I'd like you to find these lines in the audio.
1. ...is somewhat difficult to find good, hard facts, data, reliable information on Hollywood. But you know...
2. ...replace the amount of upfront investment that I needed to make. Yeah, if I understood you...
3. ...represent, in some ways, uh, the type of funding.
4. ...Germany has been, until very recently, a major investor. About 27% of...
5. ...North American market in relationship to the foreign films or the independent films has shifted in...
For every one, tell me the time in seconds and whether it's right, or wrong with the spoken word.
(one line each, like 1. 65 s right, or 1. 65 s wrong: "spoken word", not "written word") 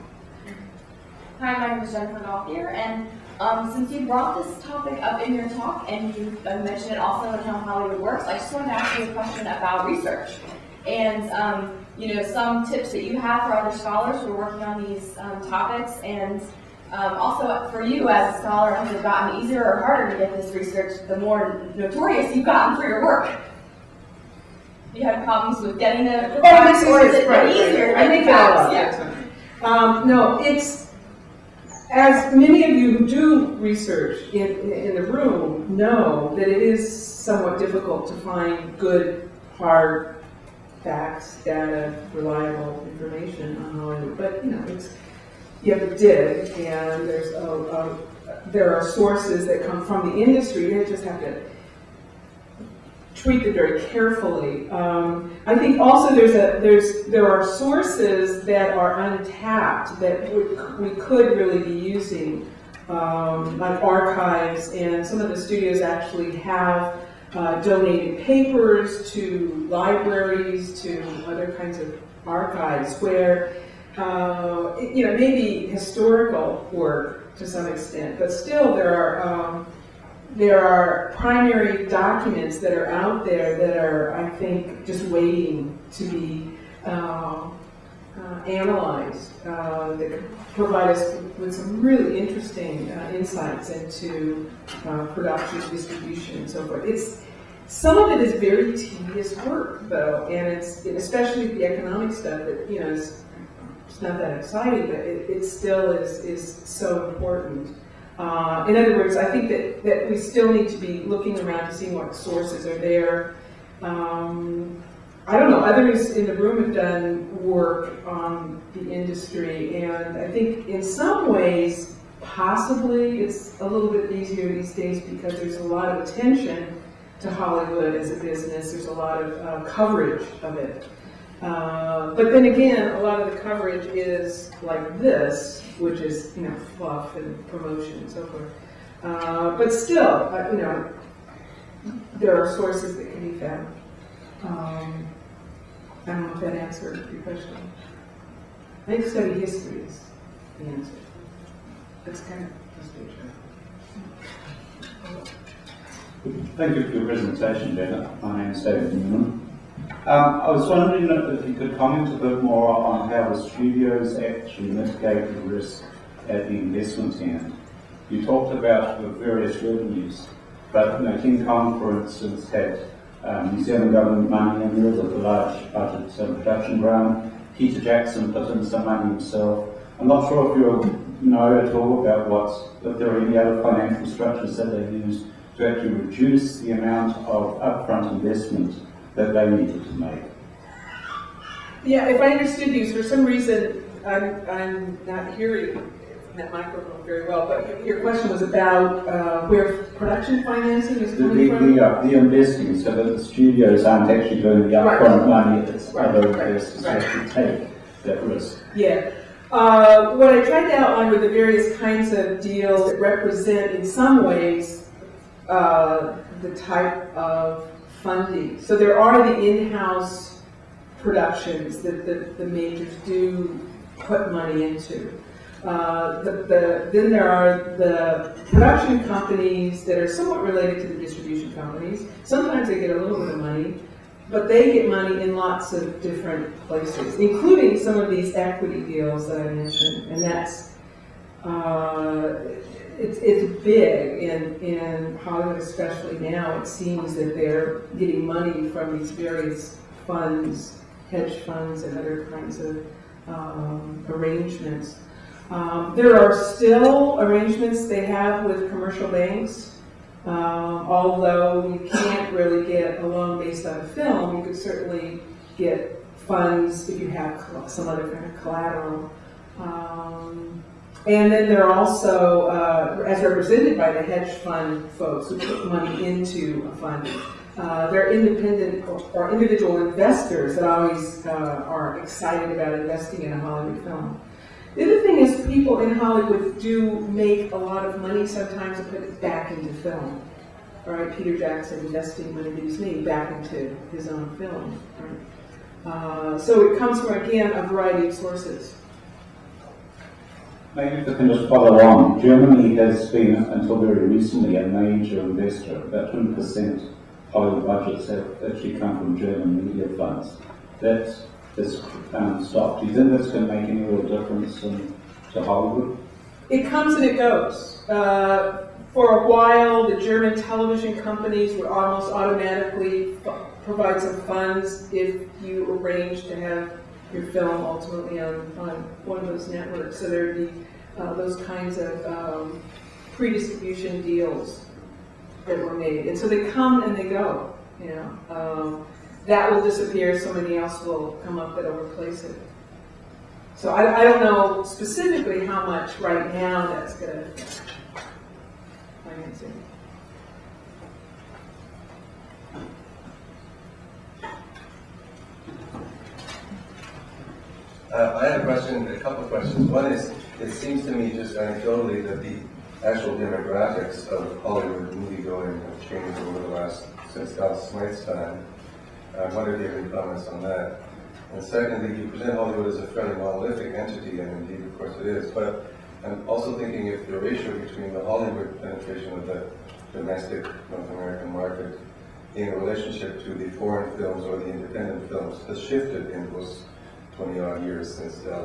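1. 36 s right
2. 185 s wrong: "reduce", not "replace"
3. 212 s right
4. 302 s wrong: "20", not "27"
5. 380 s right.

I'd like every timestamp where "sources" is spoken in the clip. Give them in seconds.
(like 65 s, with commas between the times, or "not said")
48 s, 57 s, 112 s, 142 s, 298 s.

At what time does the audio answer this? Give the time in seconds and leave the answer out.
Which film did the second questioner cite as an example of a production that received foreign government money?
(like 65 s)
171 s.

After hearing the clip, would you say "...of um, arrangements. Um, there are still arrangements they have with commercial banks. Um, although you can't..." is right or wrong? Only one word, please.
right.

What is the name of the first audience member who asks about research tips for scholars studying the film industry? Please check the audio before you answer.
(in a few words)
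Jennifer Gothier.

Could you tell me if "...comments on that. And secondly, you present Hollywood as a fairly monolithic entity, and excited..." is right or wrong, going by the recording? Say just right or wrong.
wrong.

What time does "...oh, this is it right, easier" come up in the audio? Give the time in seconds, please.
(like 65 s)
26 s.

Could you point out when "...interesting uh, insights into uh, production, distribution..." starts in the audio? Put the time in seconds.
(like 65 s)
92 s.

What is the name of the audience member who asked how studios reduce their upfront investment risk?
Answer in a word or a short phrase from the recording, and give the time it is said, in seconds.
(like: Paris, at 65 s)
David Newman, at 158 s.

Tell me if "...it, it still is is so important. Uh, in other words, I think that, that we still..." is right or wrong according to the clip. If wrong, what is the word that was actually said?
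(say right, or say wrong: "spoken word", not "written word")
right.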